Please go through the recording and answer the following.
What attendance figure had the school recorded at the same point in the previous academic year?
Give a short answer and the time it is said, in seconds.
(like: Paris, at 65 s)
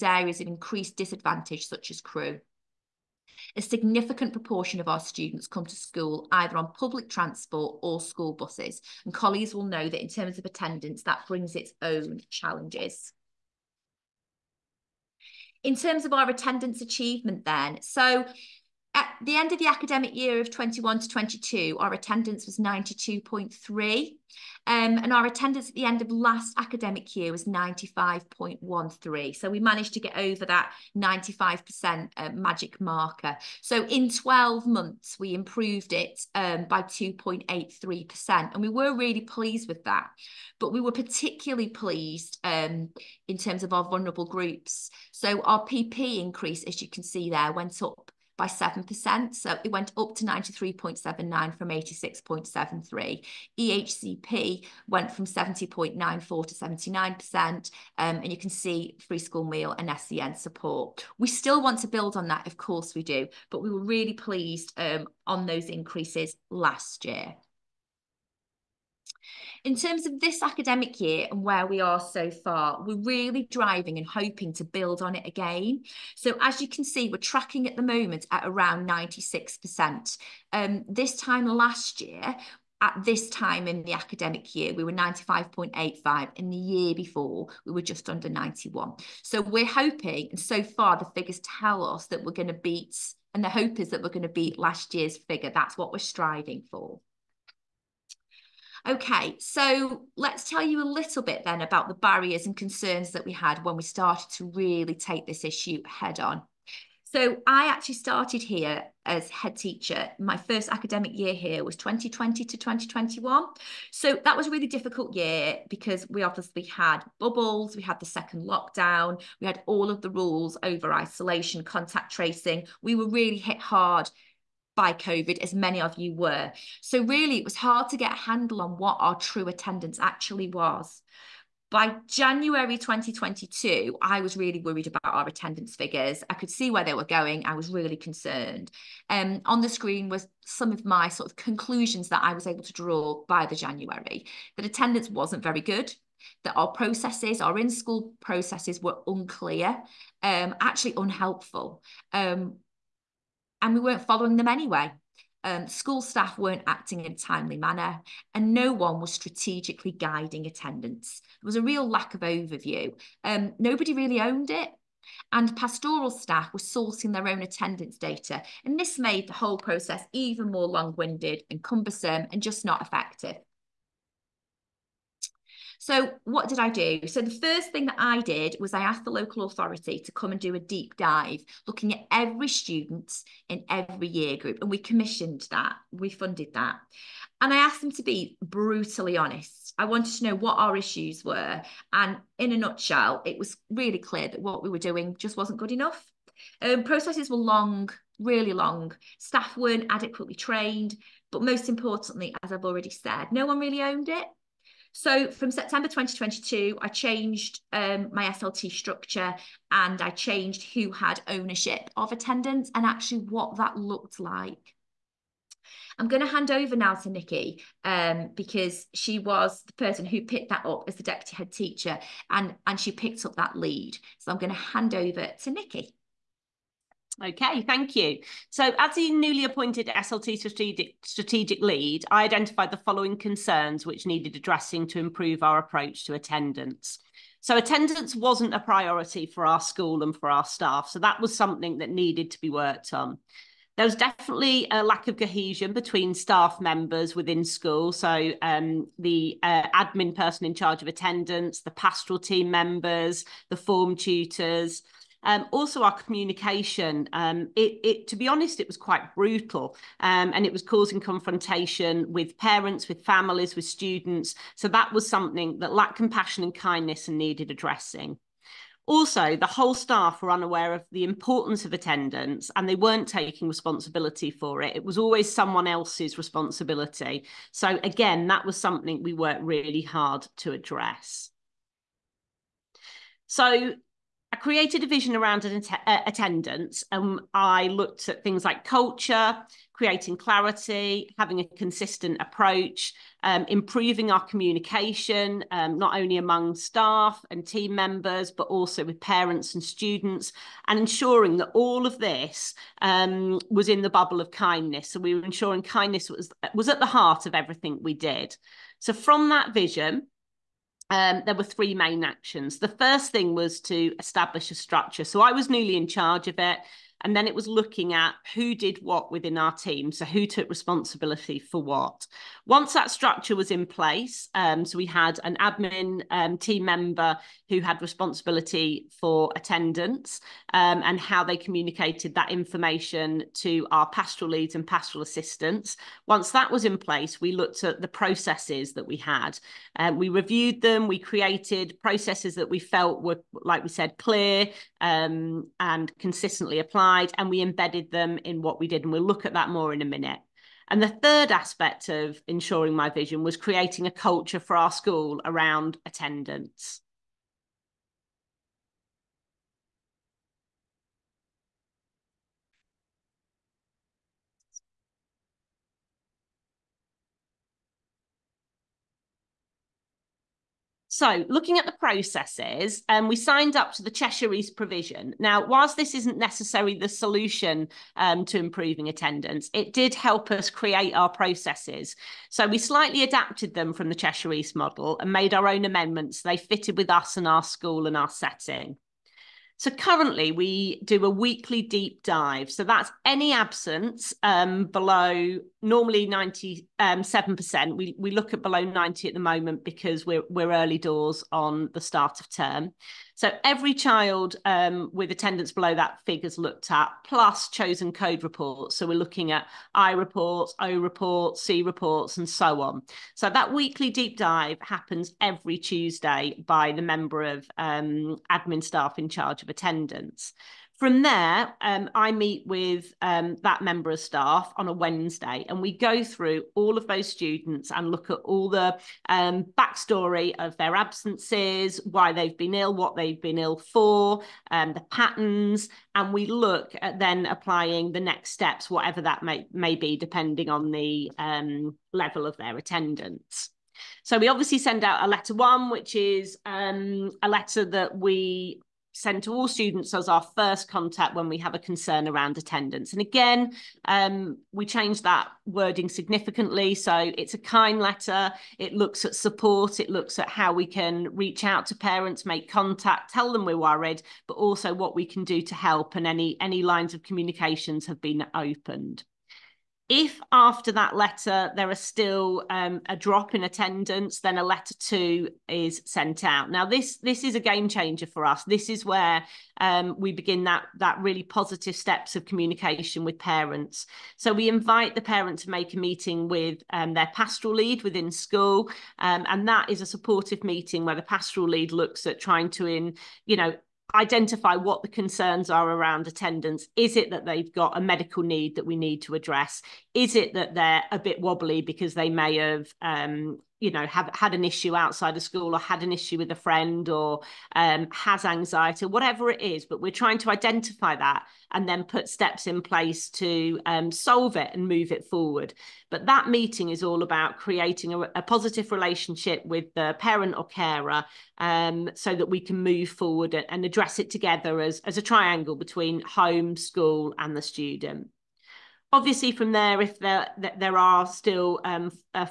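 95.85, at 84 s.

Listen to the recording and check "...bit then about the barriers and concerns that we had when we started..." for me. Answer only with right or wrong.
right.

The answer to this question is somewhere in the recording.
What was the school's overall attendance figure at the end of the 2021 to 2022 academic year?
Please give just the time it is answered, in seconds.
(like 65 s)
22 s.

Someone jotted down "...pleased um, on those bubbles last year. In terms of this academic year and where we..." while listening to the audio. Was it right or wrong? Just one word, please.
wrong.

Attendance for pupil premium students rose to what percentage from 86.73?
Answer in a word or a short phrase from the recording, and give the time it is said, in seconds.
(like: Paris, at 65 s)
93.79, at 50 s.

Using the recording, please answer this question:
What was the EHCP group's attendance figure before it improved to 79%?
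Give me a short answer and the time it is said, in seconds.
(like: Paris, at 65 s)
70.94, at 55 s.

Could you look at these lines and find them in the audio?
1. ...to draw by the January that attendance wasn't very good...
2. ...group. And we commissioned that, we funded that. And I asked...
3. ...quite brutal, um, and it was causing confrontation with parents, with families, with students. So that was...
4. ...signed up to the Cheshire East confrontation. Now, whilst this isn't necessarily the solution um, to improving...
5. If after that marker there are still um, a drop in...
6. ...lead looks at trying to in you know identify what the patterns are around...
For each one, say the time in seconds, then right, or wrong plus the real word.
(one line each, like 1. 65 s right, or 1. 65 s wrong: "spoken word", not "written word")
1. 142 s right
2. 184 s right
3. 258 s right
4. 373 s wrong: "provision", not "confrontation"
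5. 469 s wrong: "letter", not "marker"
6. 491 s wrong: "concerns", not "patterns".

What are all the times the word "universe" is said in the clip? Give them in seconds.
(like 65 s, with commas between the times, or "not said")
not said.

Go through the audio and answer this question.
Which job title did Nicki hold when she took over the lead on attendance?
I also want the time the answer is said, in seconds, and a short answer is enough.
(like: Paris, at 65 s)
deputy head teacher, at 221 s.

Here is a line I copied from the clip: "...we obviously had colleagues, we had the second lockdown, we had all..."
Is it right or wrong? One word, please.
wrong.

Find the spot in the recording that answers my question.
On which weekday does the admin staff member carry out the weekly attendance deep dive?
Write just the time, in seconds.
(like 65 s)
415 s.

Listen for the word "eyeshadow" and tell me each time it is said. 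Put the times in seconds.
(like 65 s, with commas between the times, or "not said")
not said.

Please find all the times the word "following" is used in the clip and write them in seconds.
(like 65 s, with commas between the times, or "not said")
154 s, 232 s.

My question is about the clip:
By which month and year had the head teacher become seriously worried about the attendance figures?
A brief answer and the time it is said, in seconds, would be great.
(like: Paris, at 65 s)
January 2022, at 132 s.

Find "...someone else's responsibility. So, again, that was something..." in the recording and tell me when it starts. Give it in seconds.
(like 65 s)
275 s.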